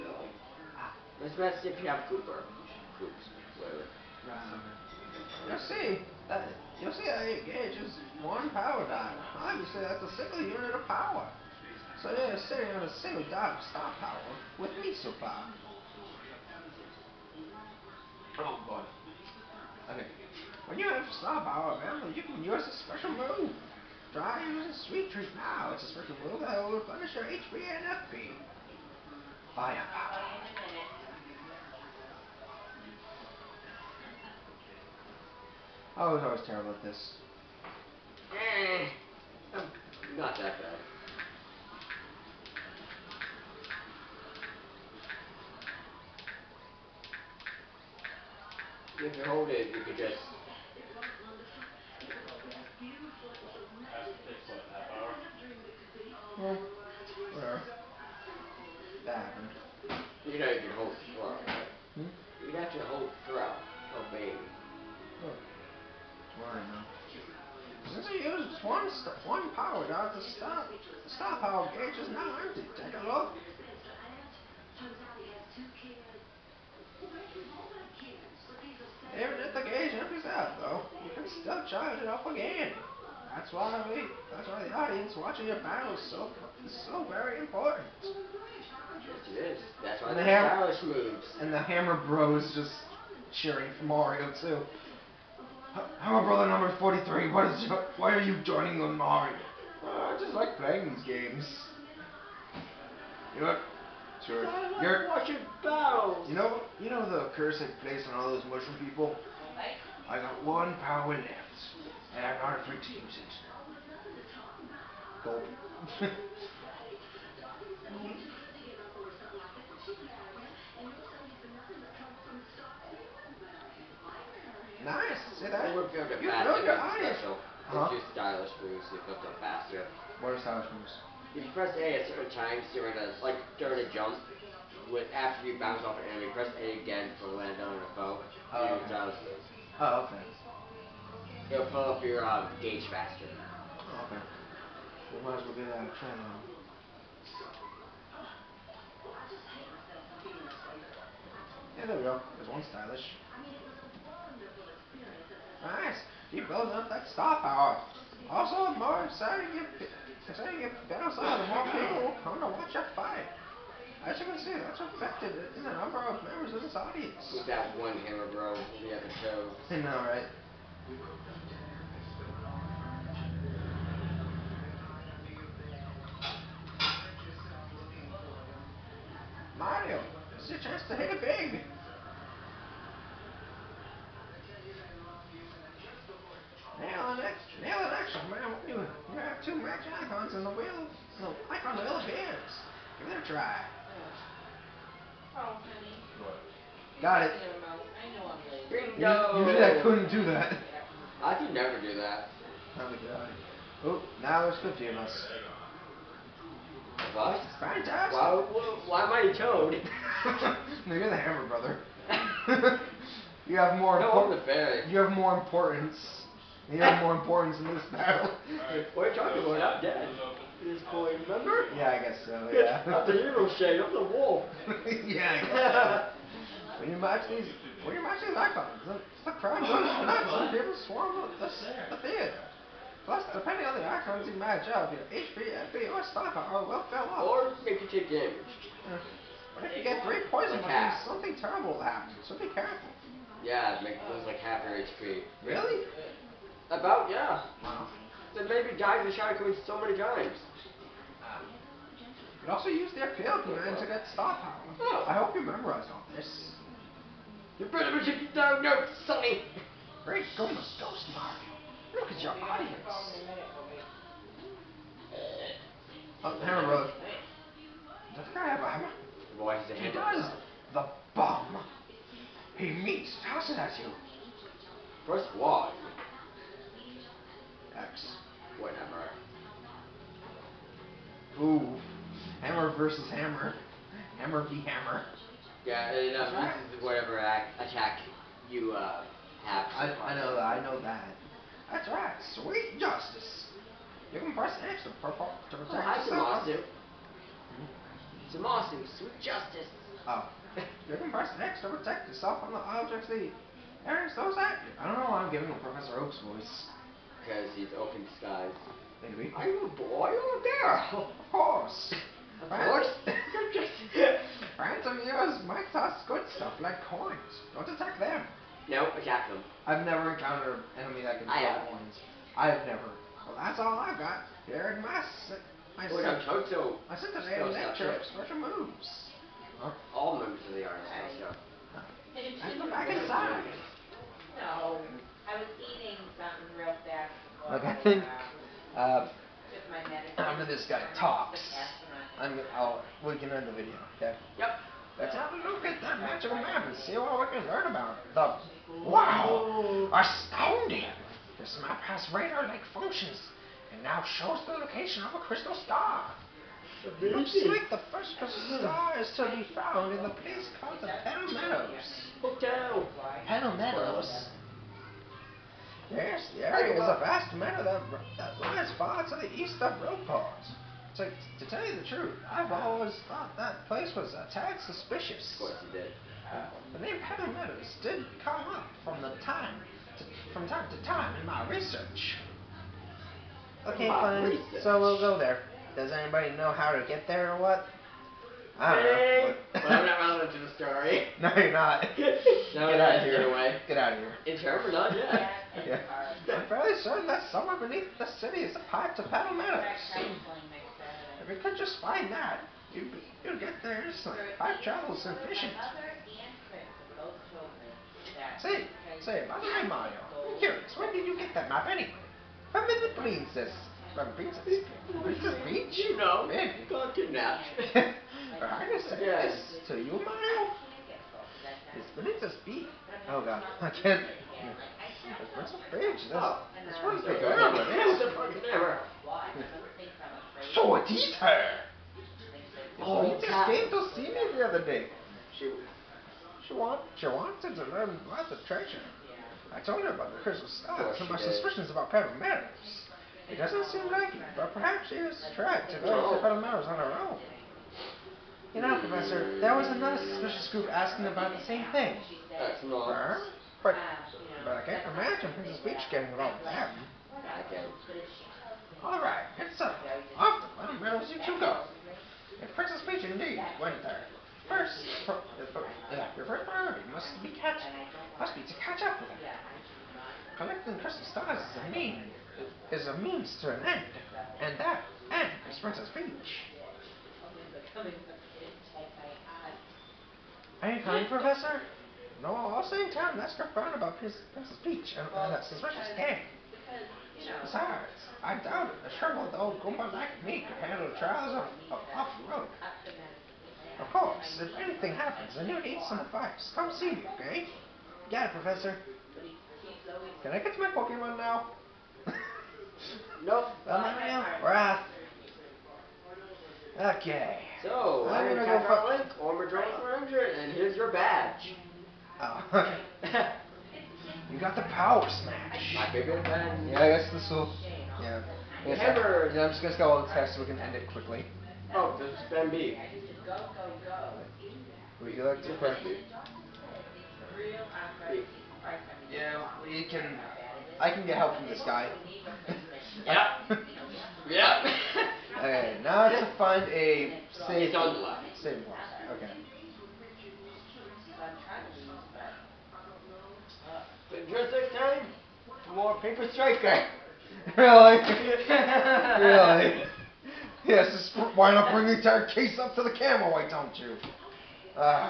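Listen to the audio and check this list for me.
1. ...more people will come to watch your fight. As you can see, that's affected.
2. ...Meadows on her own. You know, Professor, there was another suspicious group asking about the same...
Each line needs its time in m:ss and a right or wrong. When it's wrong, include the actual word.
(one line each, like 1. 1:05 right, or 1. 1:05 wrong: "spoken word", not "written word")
1. 2:41 right
2. 7:26 right.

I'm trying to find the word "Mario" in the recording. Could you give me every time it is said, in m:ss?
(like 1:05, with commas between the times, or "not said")
1:33, 1:38, 6:49, 7:00.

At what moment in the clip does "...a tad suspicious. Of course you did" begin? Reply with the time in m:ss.
6:14.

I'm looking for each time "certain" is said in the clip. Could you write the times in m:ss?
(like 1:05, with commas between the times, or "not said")
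2:12, 6:36.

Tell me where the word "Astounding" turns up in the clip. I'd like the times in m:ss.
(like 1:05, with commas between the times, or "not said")
5:49.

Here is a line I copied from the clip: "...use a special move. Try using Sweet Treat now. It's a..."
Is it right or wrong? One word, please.
right.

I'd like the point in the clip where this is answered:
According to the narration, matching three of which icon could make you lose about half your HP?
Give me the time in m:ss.
4:00.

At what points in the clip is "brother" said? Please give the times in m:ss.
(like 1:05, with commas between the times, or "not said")
1:36, 3:31, 4:26.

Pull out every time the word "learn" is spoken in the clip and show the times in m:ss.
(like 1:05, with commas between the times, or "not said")
5:47, 7:17.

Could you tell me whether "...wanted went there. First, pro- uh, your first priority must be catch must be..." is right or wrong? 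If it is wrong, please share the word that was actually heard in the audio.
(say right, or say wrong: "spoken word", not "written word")
wrong: "indeed", not "wanted".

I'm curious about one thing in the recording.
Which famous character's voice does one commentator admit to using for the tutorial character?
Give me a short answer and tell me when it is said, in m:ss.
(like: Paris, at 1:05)
Professor Oak, at 5:05.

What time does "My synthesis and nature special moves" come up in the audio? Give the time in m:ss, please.
5:26.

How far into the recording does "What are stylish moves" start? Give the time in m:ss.
2:10.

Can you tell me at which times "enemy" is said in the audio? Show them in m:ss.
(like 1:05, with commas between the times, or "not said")
2:16, 5:20.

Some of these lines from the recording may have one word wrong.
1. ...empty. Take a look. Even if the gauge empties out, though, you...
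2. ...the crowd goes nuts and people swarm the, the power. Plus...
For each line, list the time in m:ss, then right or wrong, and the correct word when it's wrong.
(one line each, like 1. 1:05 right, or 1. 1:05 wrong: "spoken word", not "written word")
1. 1:12 right
2. 3:49 wrong: "theater", not "power".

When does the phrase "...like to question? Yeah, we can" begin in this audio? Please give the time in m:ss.
8:45.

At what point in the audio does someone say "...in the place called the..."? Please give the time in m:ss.
5:59.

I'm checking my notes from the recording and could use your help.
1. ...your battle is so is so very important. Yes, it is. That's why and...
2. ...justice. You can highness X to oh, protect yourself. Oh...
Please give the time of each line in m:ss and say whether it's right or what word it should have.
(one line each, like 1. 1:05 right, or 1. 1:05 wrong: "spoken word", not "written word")
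1. 1:25 right
2. 4:52 wrong: "press", not "highness".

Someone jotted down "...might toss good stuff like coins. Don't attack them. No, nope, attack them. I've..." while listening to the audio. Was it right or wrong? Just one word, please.
right.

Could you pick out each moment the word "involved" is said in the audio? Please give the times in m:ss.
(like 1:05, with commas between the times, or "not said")
7:36.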